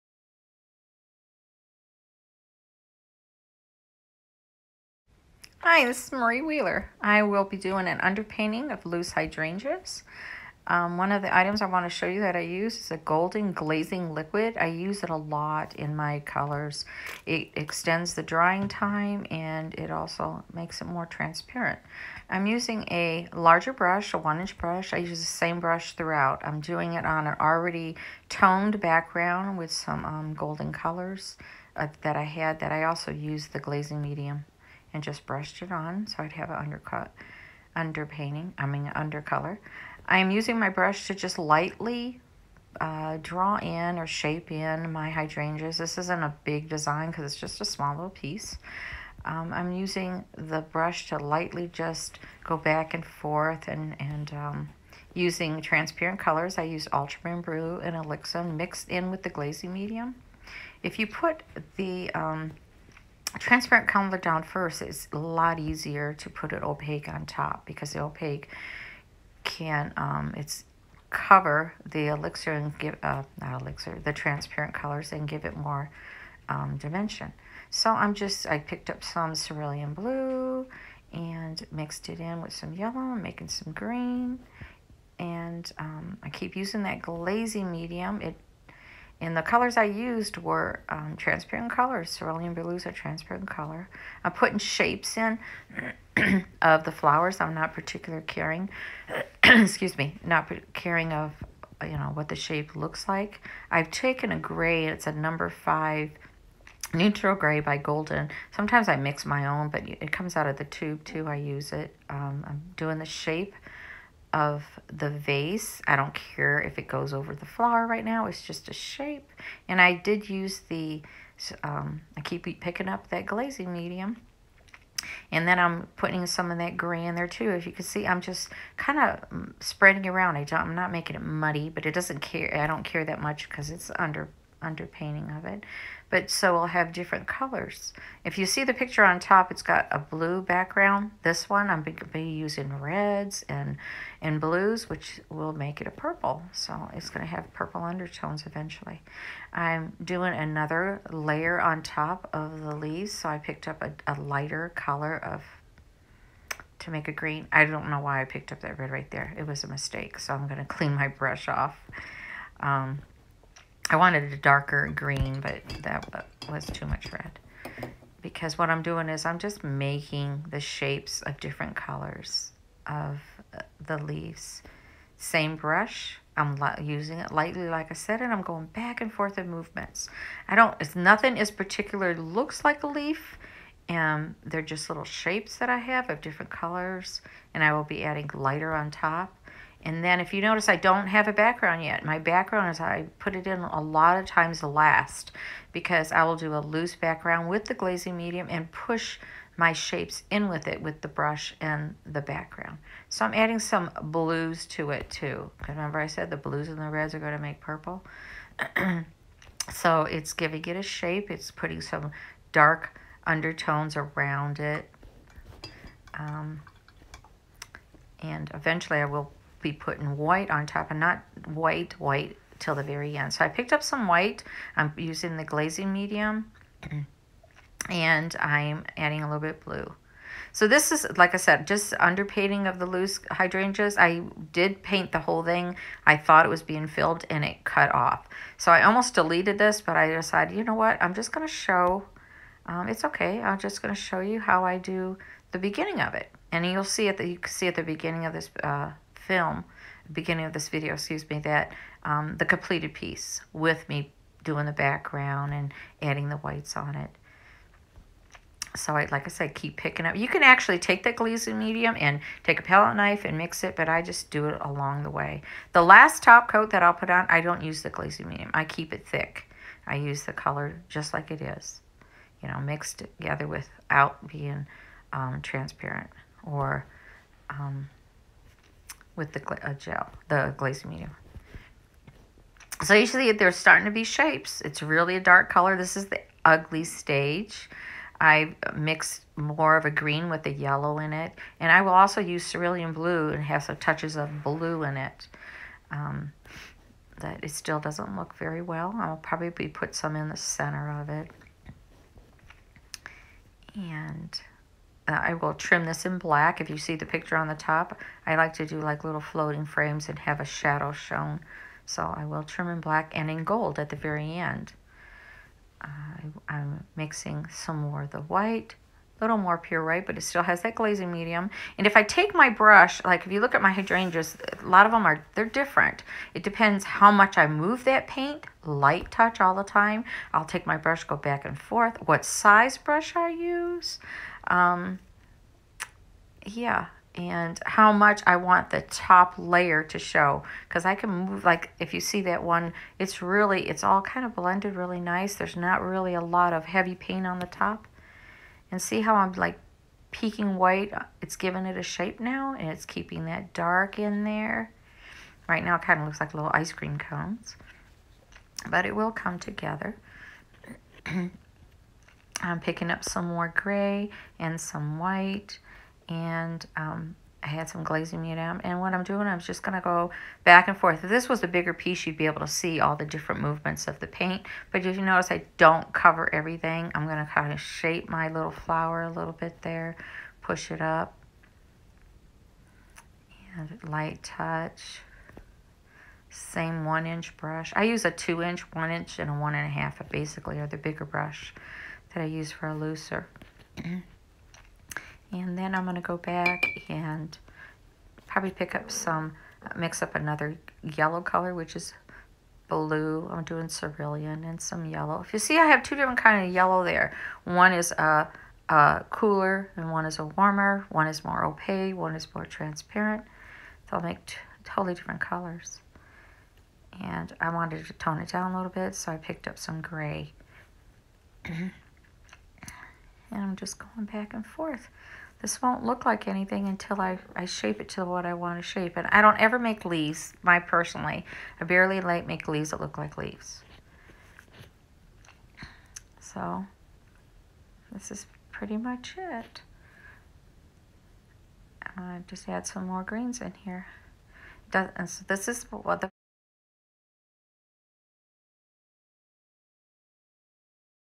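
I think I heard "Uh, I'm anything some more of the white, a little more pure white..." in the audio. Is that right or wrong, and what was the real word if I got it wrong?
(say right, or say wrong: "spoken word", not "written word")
wrong: "mixing", not "anything".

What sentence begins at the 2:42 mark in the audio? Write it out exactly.
Um, I wanted a darker green, but that was too much red.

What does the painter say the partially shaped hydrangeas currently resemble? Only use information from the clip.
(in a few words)
Little ice cream cones.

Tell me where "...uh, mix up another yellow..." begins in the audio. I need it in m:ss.
6:39.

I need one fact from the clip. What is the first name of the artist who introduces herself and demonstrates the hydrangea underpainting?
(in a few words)
Marie.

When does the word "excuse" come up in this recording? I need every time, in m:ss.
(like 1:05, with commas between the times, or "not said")
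1:39, 4:10.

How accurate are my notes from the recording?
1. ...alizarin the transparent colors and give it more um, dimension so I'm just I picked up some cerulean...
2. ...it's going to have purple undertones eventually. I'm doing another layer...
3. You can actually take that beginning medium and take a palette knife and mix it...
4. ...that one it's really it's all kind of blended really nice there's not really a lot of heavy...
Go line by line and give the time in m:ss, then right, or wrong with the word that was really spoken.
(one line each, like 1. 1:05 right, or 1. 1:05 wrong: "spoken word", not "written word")
1. 1:13 right
2. 2:26 right
3. 4:20 wrong: "glazing", not "beginning"
4. 5:42 right.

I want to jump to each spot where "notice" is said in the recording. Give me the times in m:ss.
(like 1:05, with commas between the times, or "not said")
3:10, 6:15.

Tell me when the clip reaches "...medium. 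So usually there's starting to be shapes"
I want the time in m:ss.
4:40.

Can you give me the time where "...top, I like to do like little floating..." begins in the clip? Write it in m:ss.
5:07.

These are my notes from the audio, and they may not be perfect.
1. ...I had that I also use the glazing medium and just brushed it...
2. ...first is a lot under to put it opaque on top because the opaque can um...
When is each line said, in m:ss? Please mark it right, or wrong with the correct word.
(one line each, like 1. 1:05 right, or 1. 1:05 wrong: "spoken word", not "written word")
1. 0:32 right
2. 1:04 wrong: "easier", not "under".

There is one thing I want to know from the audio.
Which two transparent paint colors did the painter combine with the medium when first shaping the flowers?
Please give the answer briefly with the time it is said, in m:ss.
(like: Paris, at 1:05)
Ultramarine Blue and Alizarin, at 0:56.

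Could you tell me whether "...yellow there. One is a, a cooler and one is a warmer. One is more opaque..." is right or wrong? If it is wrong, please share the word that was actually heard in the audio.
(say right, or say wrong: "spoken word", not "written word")
right.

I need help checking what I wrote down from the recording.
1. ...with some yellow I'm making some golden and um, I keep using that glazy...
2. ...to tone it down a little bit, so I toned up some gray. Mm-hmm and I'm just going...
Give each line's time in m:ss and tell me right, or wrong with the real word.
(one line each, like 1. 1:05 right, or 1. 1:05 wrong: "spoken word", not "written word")
1. 1:22 wrong: "green", not "golden"
2. 6:57 wrong: "picked", not "toned".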